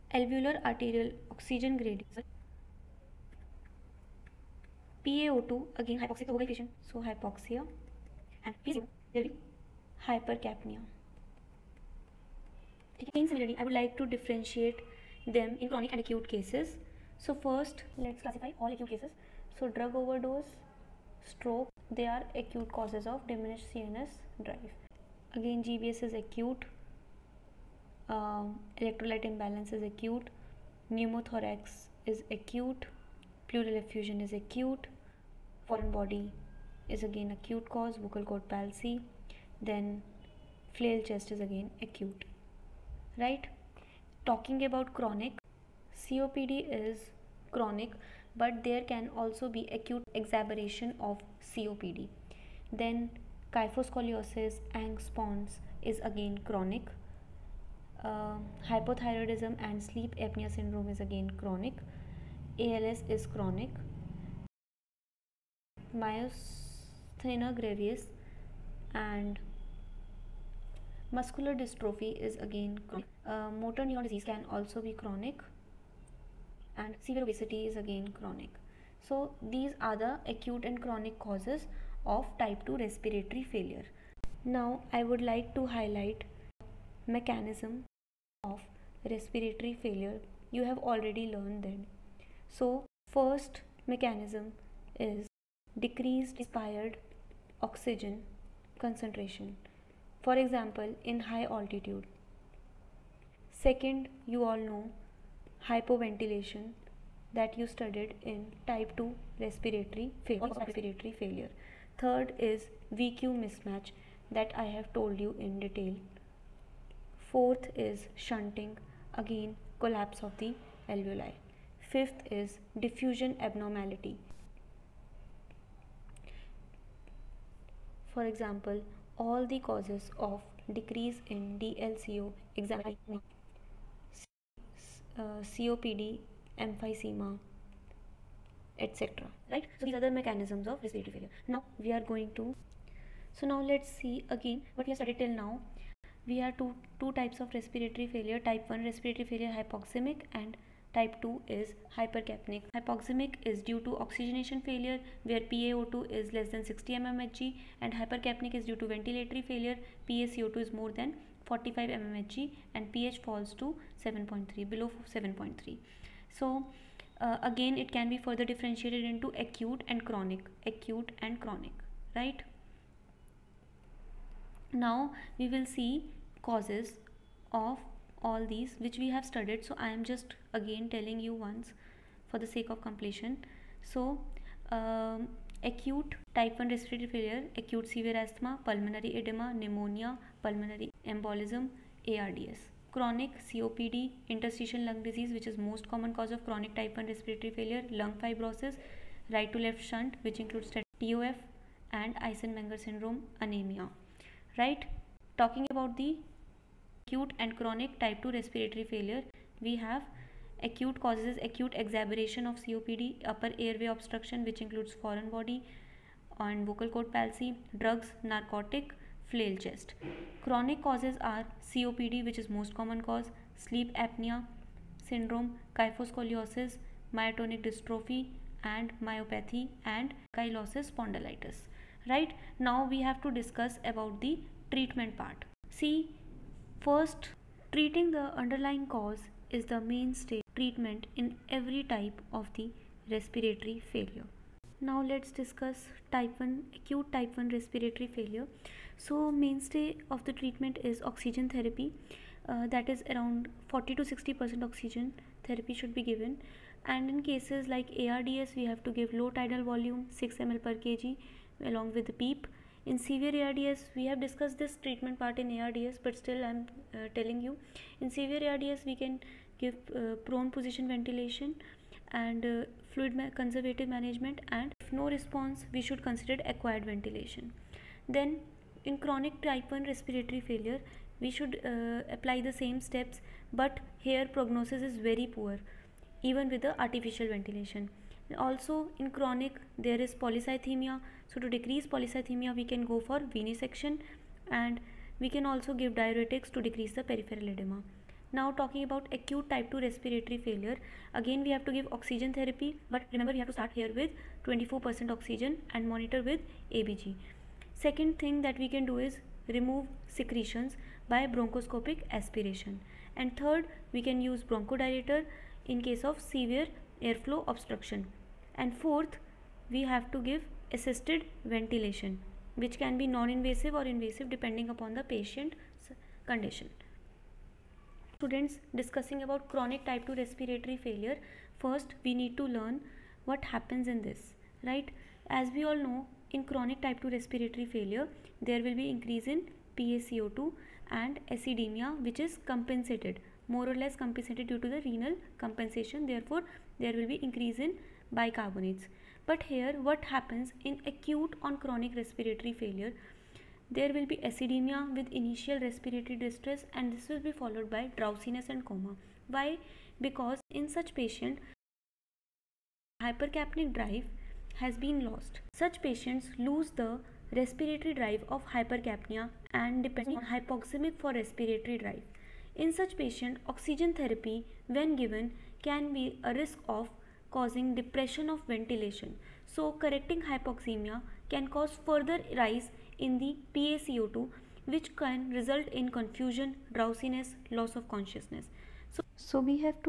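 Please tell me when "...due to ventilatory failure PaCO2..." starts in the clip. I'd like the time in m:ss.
2:38.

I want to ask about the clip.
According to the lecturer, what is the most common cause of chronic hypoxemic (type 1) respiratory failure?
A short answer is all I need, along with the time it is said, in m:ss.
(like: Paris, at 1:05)
Interstitial lung disease, at 3:14.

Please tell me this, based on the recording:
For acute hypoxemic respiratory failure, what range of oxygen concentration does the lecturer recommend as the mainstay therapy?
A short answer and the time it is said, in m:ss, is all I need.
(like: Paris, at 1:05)
40 to 60%, at 4:13.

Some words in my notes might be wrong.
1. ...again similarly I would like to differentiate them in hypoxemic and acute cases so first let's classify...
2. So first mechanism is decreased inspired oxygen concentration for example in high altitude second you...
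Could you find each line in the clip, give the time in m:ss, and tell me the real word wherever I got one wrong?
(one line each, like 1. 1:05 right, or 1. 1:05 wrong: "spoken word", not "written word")
1. 0:13 wrong: "chronic", not "hypoxemic"
2. 1:32 right.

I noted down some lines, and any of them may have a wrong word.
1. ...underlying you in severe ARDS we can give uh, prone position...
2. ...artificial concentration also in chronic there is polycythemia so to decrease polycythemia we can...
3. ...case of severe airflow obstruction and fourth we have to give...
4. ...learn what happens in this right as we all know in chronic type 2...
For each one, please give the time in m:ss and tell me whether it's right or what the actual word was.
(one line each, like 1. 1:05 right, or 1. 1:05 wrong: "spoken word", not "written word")
1. 4:27 wrong: "telling", not "underlying"
2. 4:46 wrong: "ventilation", not "concentration"
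3. 5:15 right
4. 5:32 right.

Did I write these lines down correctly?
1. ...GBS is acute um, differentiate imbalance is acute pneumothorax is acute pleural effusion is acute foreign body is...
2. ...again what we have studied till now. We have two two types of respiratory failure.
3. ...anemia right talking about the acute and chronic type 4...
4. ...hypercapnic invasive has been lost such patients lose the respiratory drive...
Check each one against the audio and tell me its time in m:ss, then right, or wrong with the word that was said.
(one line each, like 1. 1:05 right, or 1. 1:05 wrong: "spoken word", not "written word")
1. 0:25 wrong: "electrolyte", not "differentiate"
2. 2:24 right
3. 3:23 wrong: "2", not "4"
4. 6:03 wrong: "drive", not "invasive".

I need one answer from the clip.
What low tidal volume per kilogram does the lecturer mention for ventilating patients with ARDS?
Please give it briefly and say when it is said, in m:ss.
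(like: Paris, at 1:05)
6 ml per kg, at 4:20.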